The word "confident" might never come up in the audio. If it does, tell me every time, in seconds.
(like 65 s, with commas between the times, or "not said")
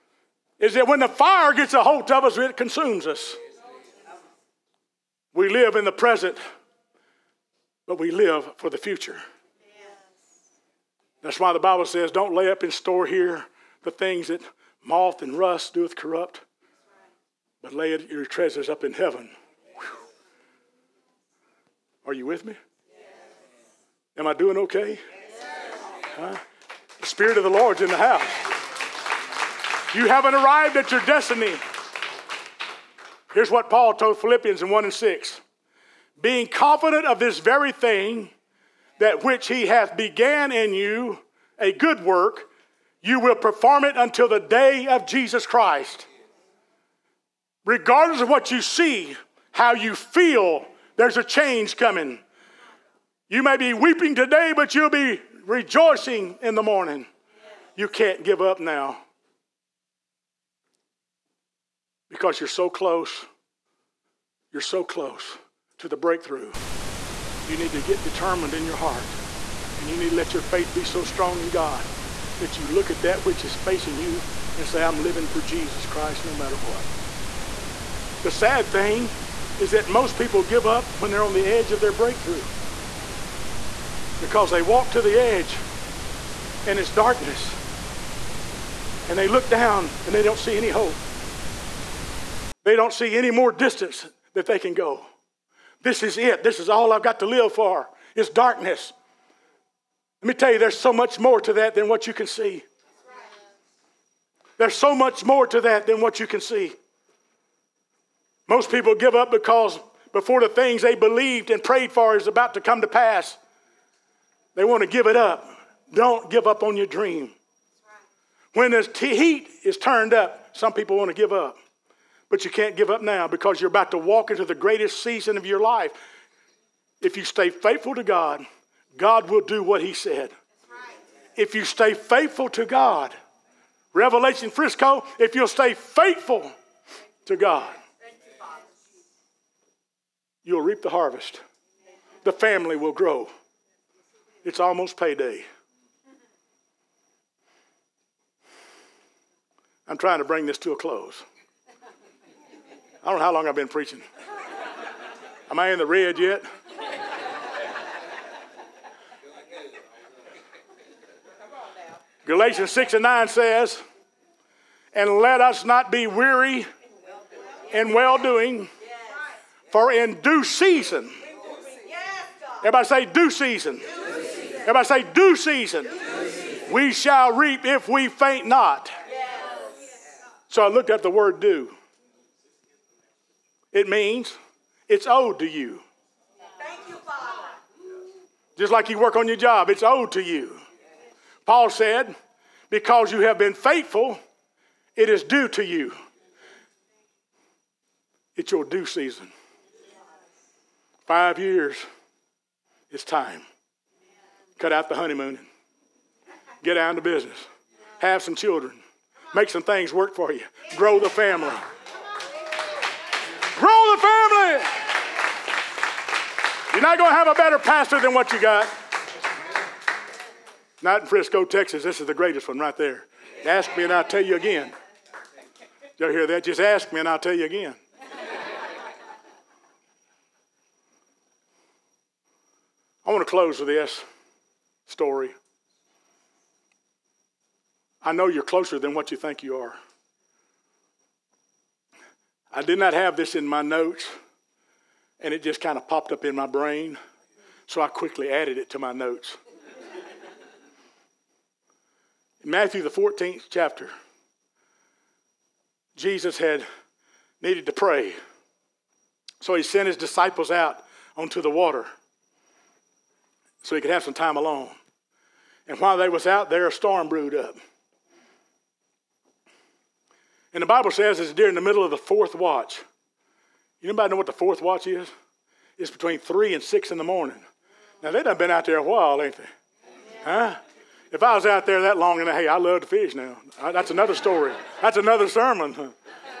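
36 s.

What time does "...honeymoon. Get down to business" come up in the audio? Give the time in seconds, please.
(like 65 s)
204 s.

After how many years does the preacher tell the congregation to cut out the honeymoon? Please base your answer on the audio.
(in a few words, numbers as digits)
5.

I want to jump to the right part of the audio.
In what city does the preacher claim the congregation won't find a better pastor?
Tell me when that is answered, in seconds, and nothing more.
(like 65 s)
221 s.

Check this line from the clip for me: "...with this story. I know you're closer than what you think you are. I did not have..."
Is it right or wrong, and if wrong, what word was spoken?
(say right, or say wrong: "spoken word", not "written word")
right.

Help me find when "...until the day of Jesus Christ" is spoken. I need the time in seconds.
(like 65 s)
43 s.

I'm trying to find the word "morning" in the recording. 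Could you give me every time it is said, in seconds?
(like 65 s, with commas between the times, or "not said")
56 s, 277 s.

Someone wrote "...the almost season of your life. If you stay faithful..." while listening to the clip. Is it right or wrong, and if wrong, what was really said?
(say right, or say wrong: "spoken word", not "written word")
wrong: "greatest", not "almost".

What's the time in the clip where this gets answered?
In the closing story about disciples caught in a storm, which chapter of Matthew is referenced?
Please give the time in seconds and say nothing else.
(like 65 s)
252 s.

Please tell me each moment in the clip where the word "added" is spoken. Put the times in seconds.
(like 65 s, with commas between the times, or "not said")
248 s.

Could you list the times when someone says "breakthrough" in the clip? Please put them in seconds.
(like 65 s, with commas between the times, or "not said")
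65 s, 81 s.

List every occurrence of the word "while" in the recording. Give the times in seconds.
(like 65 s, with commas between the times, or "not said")
265 s, 278 s.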